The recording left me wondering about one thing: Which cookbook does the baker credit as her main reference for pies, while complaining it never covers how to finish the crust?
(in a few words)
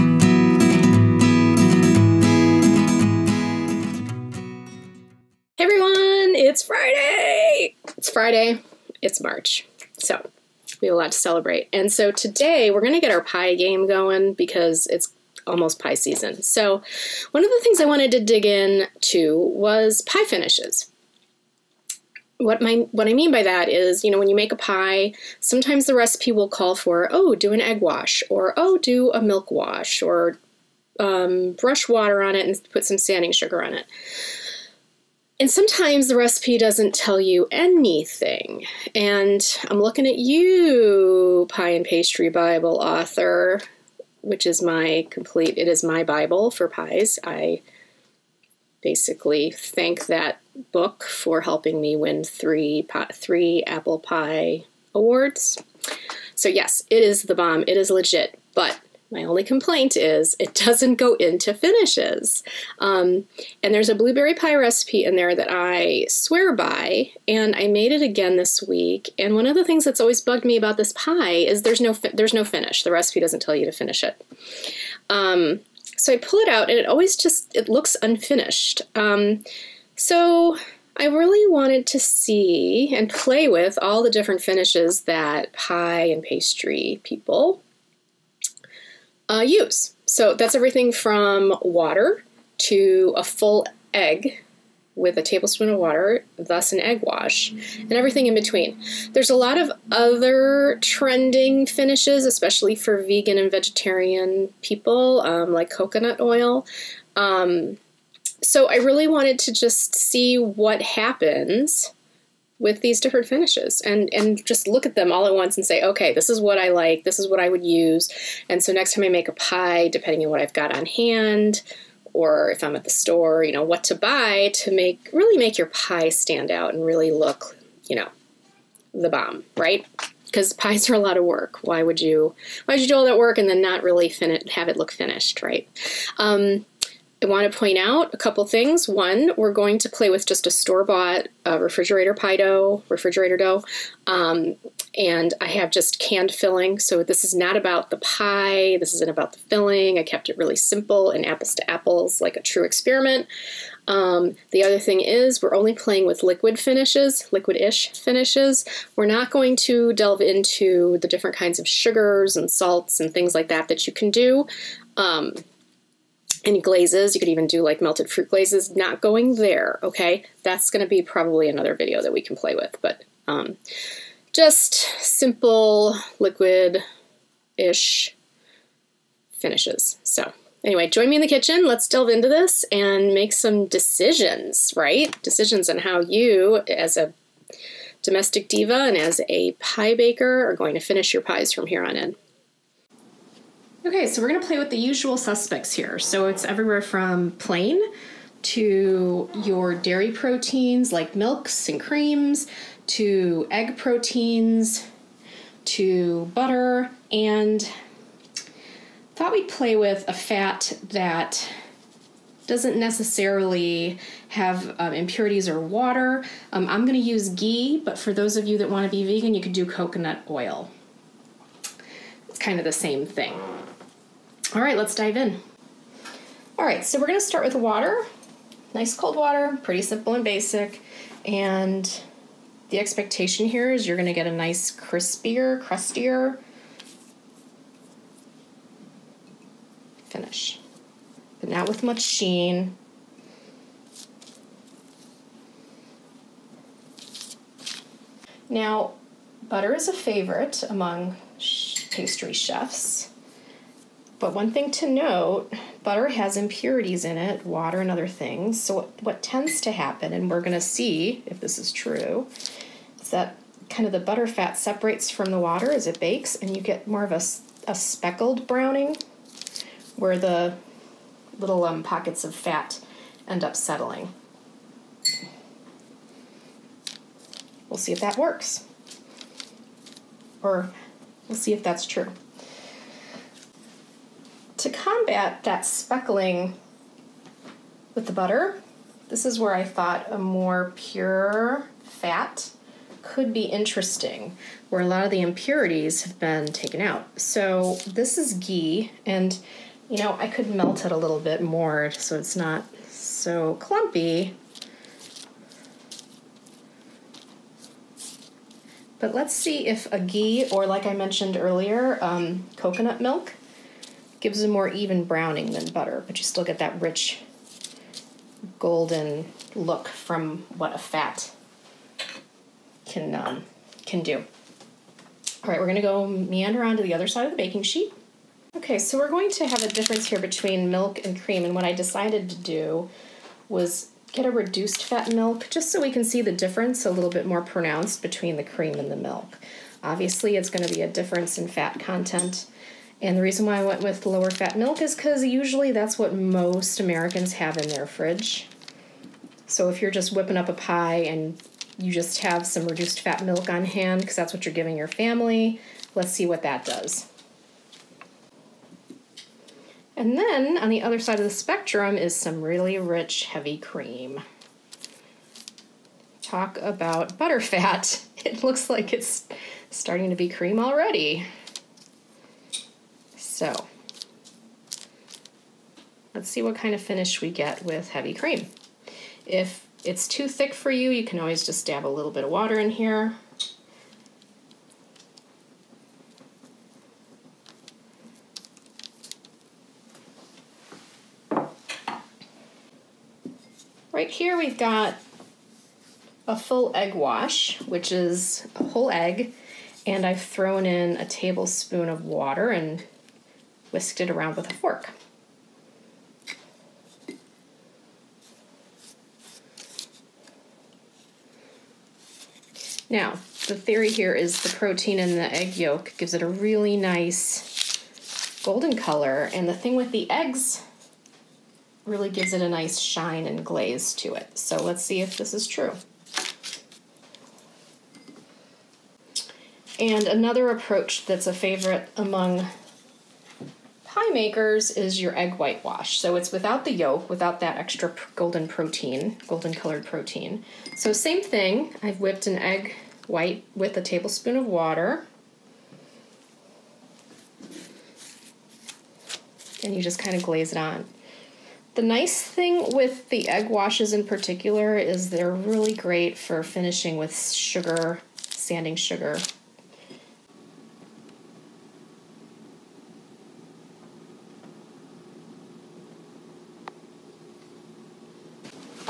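Pie and Pastry Bible.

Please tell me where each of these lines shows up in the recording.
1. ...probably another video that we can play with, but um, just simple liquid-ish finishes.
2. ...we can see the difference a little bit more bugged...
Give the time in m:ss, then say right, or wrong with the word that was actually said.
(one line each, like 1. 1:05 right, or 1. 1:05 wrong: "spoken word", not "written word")
1. 2:51 right
2. 5:35 wrong: "pronounced", not "bugged".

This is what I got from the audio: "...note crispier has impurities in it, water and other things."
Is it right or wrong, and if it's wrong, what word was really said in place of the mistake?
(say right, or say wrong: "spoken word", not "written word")
wrong: "butter", not "crispier".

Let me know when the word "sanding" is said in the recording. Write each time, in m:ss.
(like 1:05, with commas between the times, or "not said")
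0:32, 7:38.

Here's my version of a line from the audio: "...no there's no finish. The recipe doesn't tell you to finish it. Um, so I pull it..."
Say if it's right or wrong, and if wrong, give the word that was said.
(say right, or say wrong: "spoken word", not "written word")
right.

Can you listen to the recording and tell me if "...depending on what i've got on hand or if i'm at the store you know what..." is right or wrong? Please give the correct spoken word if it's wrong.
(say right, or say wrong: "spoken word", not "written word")
right.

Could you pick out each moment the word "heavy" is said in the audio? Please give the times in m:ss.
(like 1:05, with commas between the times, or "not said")
6:03, 6:17.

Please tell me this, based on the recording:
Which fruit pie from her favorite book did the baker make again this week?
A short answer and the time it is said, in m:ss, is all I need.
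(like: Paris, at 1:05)
blueberry, at 1:03.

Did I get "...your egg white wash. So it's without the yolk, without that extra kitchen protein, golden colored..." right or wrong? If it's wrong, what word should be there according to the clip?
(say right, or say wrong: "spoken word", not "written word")
wrong: "golden", not "kitchen".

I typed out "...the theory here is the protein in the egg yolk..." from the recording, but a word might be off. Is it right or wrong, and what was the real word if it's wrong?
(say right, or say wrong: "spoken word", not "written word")
right.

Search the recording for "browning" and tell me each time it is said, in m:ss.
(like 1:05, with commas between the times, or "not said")
4:28, 5:15.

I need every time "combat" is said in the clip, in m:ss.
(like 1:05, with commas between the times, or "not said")
4:44.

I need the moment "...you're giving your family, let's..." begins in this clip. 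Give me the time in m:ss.
5:54.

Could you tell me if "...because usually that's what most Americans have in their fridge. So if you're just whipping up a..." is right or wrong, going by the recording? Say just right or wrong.
right.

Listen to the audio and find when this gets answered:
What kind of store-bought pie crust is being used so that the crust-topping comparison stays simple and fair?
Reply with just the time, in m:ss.
2:21.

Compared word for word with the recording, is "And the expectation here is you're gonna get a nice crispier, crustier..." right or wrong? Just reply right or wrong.
right.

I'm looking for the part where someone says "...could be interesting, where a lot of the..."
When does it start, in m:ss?
4:53.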